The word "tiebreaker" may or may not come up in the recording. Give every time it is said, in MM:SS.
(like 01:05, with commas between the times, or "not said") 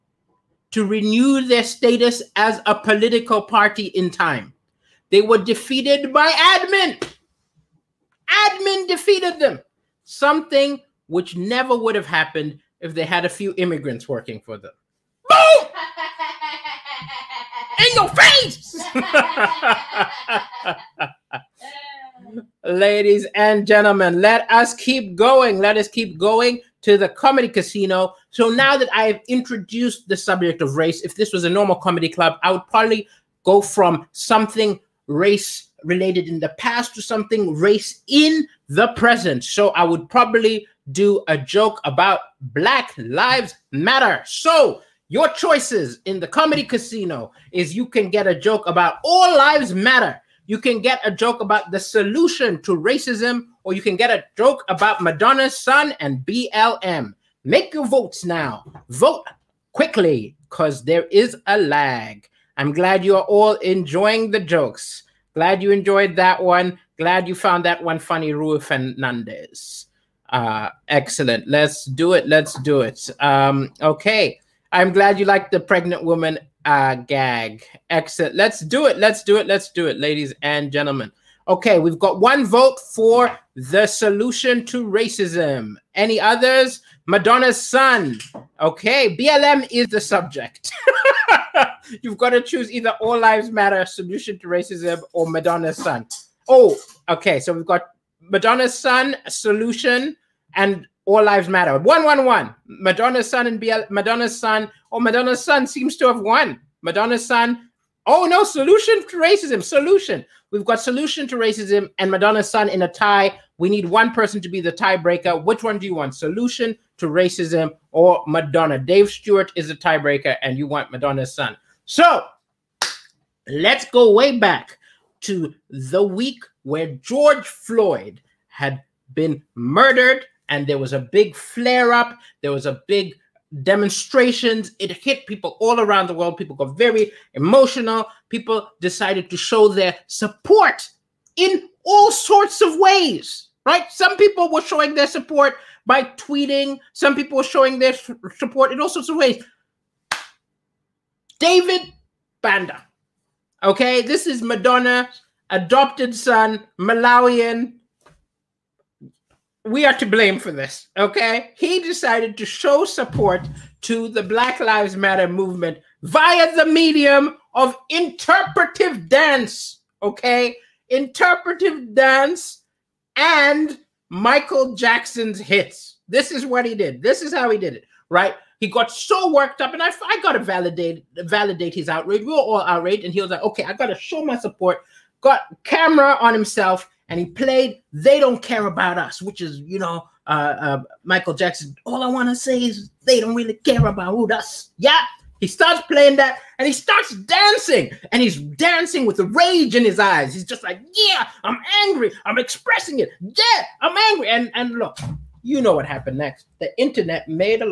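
01:54, 01:59.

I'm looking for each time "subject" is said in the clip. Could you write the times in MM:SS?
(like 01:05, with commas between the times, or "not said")
00:30, 01:29.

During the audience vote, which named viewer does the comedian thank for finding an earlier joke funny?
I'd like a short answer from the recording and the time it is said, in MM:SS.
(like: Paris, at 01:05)
Rui Fernandez, at 01:08.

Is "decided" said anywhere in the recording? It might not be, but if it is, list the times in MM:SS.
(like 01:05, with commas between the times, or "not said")
02:18, 02:41.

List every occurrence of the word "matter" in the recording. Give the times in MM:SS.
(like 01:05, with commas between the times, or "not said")
00:43, 00:49, 01:33, 01:41, 02:44.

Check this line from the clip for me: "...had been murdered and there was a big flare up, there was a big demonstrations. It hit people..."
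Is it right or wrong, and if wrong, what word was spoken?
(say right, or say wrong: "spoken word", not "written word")
right.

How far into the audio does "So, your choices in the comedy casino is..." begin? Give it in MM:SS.
00:44.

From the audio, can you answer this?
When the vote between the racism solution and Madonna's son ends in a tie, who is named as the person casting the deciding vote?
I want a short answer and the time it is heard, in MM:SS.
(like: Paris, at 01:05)
Dave Stewart, at 01:58.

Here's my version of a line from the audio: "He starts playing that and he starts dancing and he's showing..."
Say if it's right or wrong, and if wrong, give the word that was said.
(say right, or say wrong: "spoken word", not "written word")
wrong: "dancing", not "showing".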